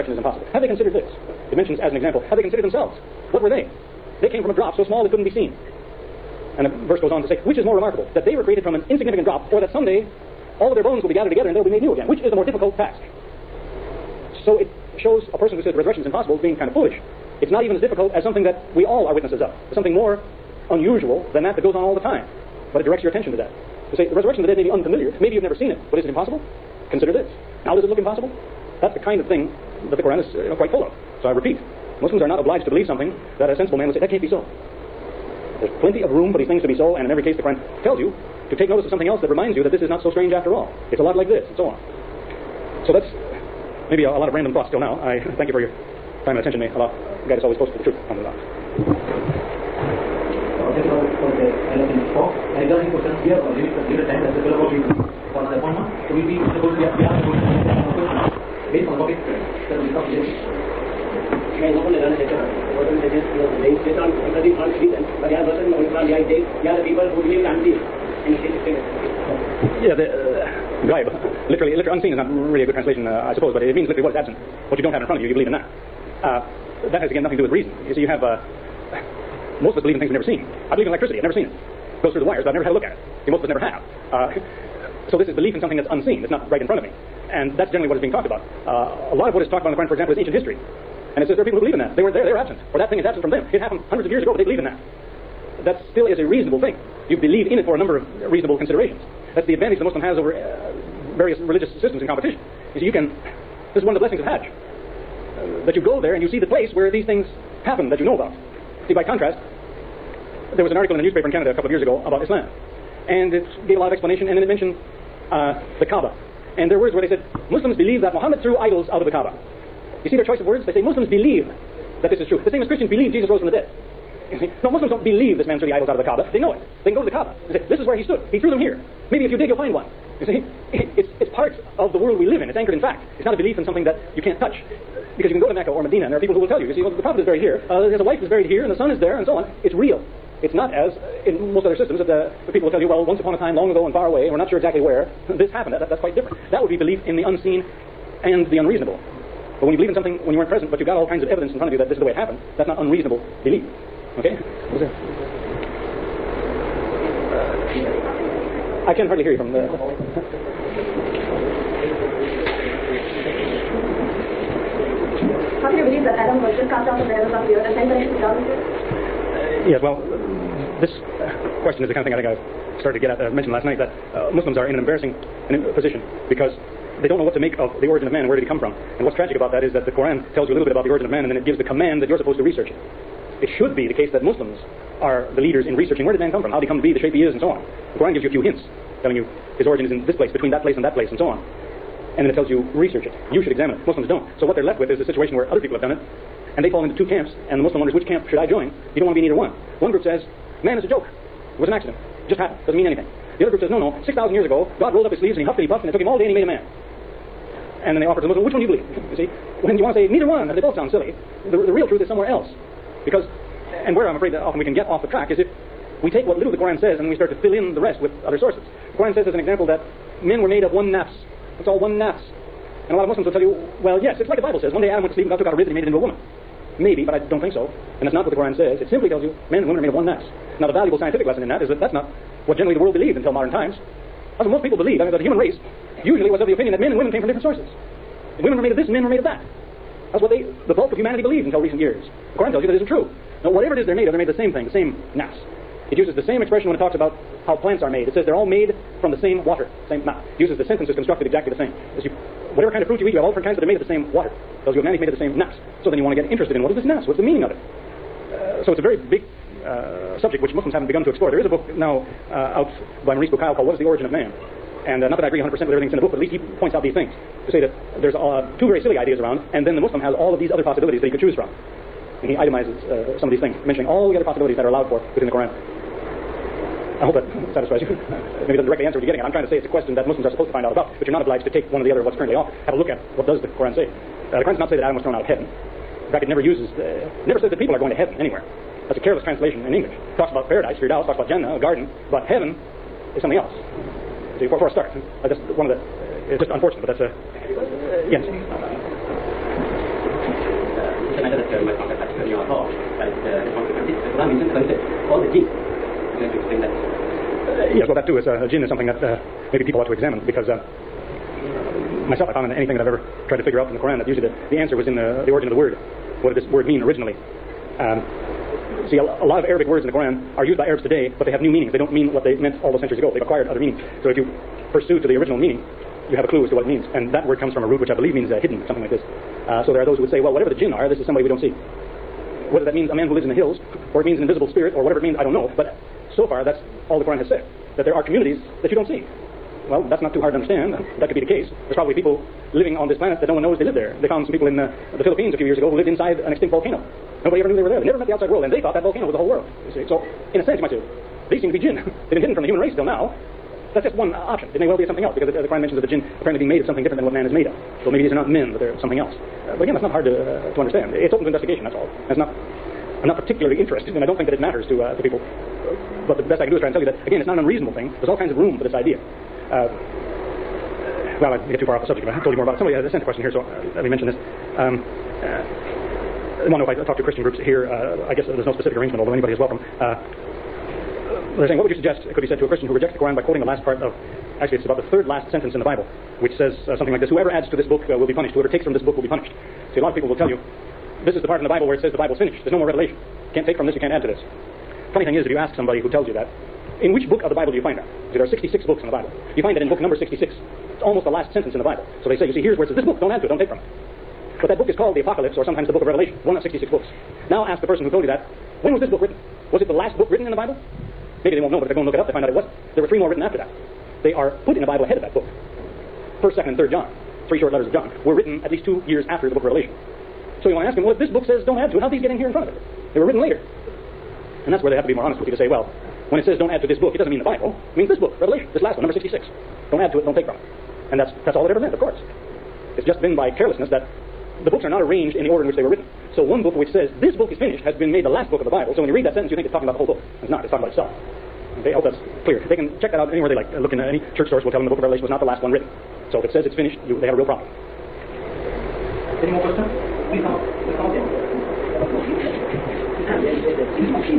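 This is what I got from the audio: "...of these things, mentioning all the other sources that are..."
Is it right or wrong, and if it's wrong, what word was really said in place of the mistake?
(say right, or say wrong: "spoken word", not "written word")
wrong: "possibilities", not "sources".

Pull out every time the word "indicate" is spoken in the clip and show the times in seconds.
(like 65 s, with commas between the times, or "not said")
not said.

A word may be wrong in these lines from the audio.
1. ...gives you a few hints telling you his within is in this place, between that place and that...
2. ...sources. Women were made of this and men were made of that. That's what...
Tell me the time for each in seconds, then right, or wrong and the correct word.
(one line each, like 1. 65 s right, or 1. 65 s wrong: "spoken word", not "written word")
1. 188 s wrong: "origin", not "within"
2. 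237 s right.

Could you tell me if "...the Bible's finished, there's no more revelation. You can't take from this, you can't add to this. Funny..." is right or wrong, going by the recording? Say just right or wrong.
right.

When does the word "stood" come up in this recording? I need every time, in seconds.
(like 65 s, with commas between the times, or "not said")
128 s.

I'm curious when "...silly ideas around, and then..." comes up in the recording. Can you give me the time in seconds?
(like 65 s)
268 s.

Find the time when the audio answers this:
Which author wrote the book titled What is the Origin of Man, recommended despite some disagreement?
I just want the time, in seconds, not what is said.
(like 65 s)
263 s.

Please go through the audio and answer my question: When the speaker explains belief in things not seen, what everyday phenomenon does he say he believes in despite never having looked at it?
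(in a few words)
Electricity.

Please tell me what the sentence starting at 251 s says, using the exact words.
As you, whatever kind of fruit you eat, you have all different kinds, but they're made of the same water.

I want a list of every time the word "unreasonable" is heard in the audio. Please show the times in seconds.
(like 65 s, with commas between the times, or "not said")
148 s, 152 s, 367 s.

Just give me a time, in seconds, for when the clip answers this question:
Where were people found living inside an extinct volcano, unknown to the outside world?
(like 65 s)
344 s.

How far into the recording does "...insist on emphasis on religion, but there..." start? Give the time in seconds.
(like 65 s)
63 s.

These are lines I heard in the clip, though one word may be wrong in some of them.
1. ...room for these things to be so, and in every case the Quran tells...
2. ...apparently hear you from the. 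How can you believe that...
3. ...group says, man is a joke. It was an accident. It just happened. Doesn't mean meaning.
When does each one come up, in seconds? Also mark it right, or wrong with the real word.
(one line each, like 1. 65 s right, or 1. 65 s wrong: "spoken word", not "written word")
1. 36 s right
2. 159 s wrong: "hardly", not "apparently"
3. 199 s wrong: "anything", not "meaning".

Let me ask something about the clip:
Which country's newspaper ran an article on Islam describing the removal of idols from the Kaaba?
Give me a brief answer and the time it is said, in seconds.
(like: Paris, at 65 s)
Canada, at 111 s.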